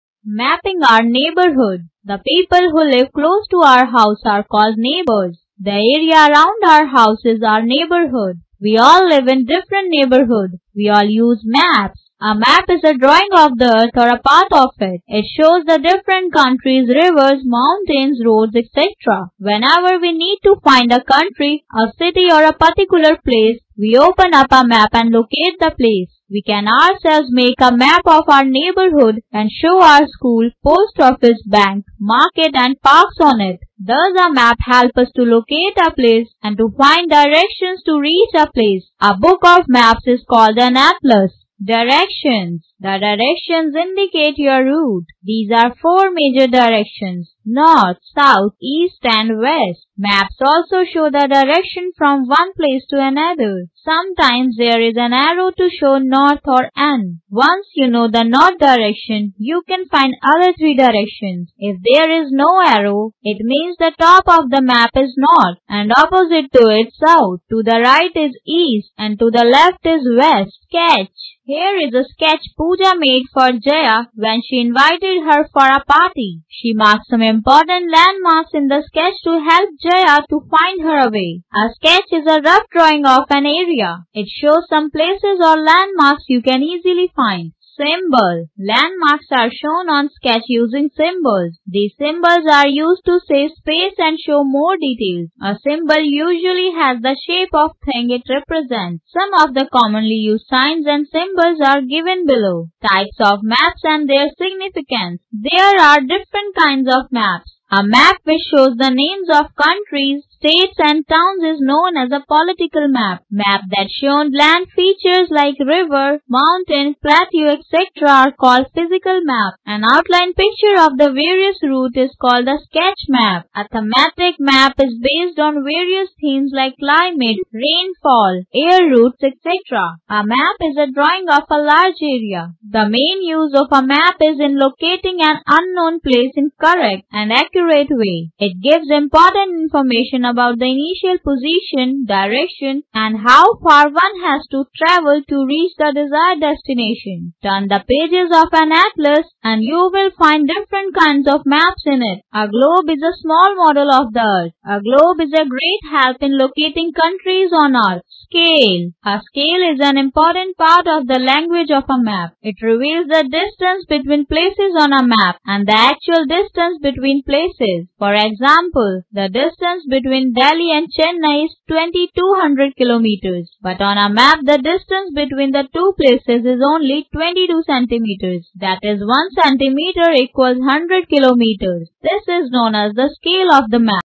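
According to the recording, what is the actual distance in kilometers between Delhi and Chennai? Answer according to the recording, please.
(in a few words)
2200 kilometers.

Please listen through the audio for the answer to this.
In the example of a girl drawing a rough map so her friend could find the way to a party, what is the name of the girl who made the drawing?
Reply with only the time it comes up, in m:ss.
1:12.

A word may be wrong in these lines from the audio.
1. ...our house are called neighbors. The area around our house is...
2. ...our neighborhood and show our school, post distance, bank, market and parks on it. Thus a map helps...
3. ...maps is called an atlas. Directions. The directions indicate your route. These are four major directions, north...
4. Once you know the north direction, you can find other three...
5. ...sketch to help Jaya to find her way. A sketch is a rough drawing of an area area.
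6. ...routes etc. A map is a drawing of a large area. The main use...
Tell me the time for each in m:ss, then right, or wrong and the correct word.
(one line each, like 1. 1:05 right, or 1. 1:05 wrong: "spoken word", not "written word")
1. 0:03 right
2. 0:28 wrong: "office", not "distance"
3. 0:39 right
4. 0:57 right
5. 1:18 right
6. 2:08 right.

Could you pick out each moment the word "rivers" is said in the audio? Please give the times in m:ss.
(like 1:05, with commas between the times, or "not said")
0:16, 1:55.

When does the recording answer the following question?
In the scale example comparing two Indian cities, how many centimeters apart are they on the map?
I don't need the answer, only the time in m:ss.
2:57.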